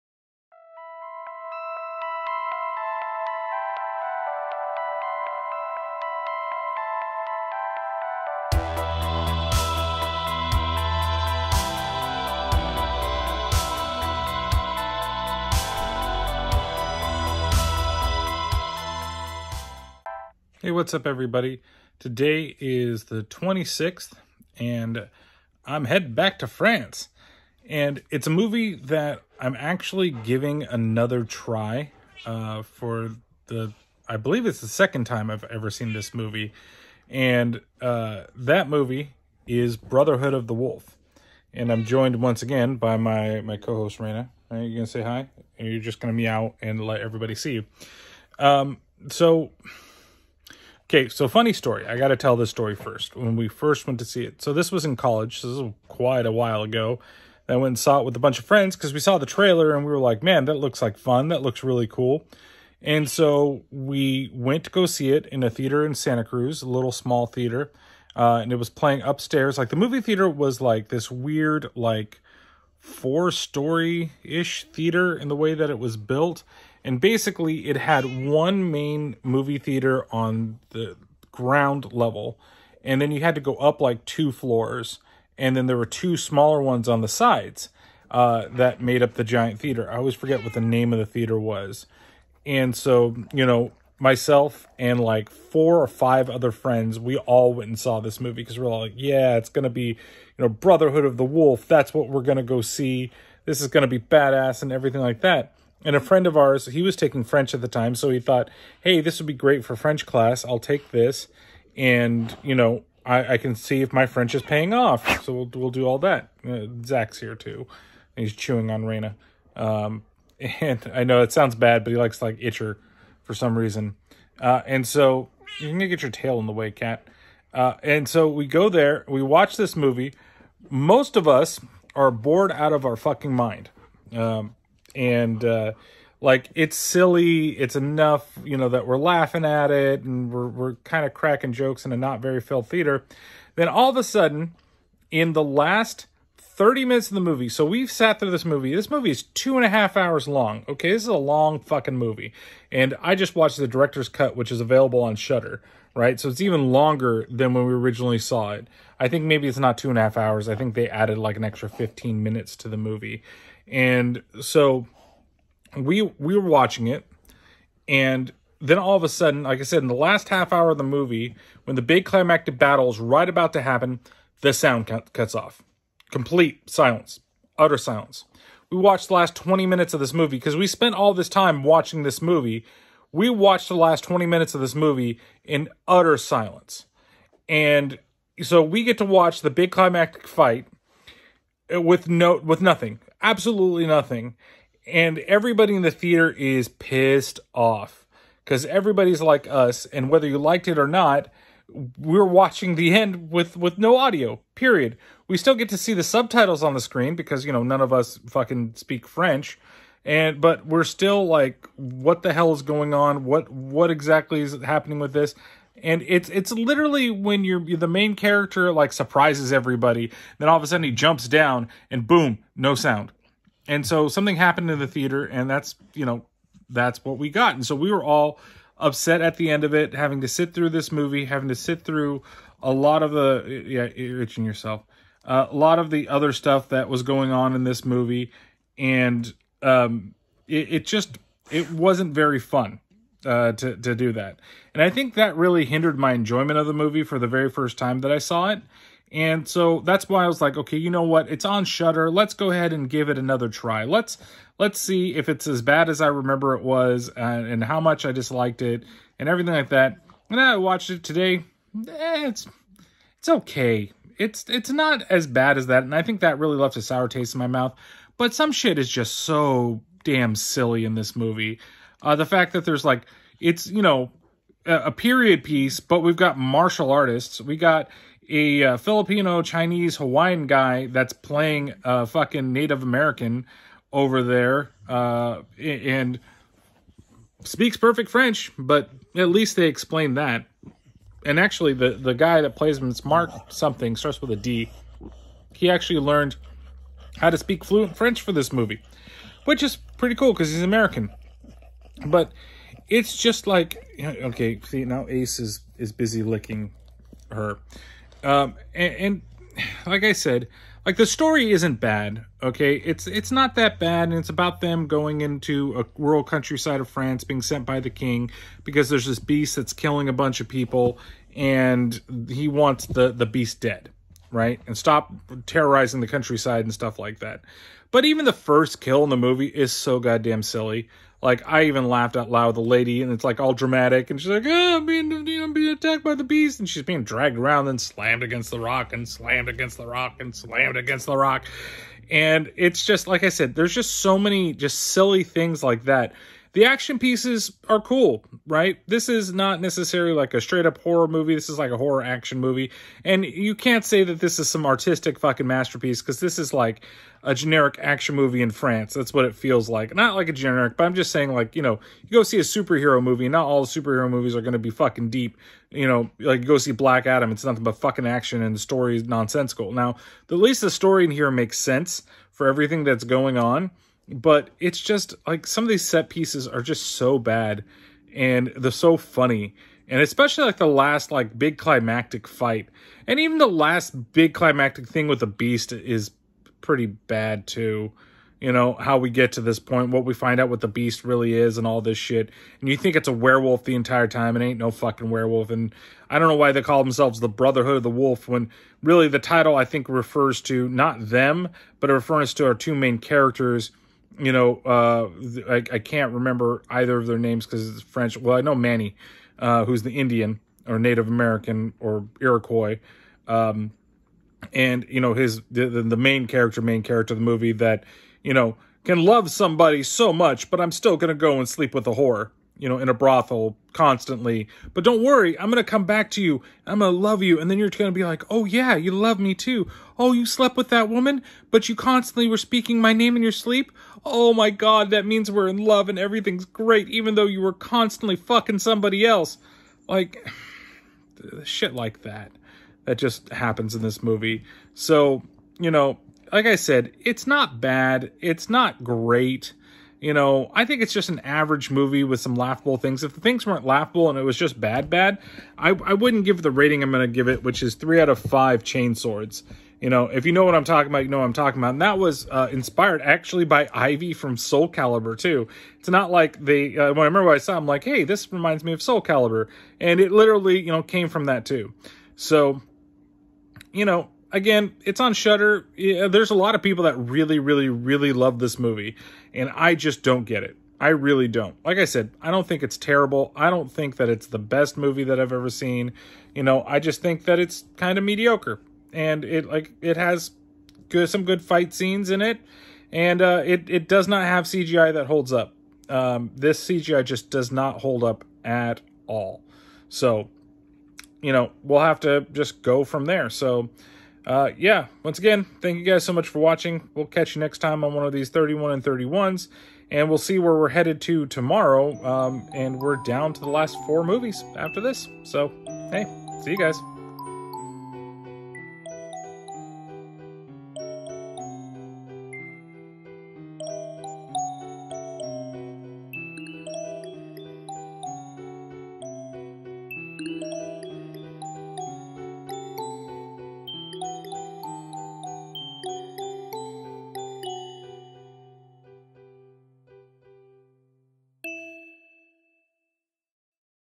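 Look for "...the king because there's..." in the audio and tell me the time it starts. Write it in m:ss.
5:17.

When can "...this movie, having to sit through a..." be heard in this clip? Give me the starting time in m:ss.
3:50.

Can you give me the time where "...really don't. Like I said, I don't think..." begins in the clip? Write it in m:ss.
8:00.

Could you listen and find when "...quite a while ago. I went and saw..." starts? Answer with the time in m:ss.
0:55.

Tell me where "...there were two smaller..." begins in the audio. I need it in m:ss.
1:25.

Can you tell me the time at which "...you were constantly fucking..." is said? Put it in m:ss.
7:17.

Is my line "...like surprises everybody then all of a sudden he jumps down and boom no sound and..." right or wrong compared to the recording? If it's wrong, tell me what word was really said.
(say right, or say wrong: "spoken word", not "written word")
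right.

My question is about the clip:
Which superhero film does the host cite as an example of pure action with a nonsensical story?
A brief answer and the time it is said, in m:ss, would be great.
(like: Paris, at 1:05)
Black Adam, at 6:06.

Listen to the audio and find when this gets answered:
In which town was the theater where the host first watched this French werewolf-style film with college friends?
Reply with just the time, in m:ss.
1:05.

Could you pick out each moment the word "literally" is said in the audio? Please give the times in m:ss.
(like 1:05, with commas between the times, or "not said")
3:36, 7:50.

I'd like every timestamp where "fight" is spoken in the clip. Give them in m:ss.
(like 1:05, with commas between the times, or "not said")
3:10, 6:22, 8:11.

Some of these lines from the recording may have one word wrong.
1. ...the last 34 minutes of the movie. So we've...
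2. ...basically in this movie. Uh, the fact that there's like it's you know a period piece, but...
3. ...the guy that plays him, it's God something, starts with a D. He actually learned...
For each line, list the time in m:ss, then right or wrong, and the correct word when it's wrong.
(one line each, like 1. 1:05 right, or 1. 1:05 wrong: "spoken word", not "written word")
1. 2:25 wrong: "30", not "34"
2. 4:30 wrong: "silly", not "basically"
3. 4:51 wrong: "Mark", not "God".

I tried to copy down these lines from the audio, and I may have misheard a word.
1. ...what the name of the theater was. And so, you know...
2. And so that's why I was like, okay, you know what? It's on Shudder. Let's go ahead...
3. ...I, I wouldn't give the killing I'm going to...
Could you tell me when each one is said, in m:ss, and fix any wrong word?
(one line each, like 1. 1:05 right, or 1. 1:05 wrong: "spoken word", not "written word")
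1. 1:30 right
2. 4:09 right
3. 7:35 wrong: "rating", not "killing".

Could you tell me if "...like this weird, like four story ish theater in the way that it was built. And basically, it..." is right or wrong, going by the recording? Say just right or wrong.
right.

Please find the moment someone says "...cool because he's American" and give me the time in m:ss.
5:00.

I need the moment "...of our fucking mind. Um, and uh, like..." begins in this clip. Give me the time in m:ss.
2:12.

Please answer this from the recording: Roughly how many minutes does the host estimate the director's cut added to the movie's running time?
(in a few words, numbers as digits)
15.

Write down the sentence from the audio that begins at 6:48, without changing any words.
Well, I know Mani, uh, who's the Indian or Native American or Iroquois.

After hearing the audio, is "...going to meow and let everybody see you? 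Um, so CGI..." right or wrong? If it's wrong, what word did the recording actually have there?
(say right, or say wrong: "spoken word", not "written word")
wrong: "Okay", not "CGI".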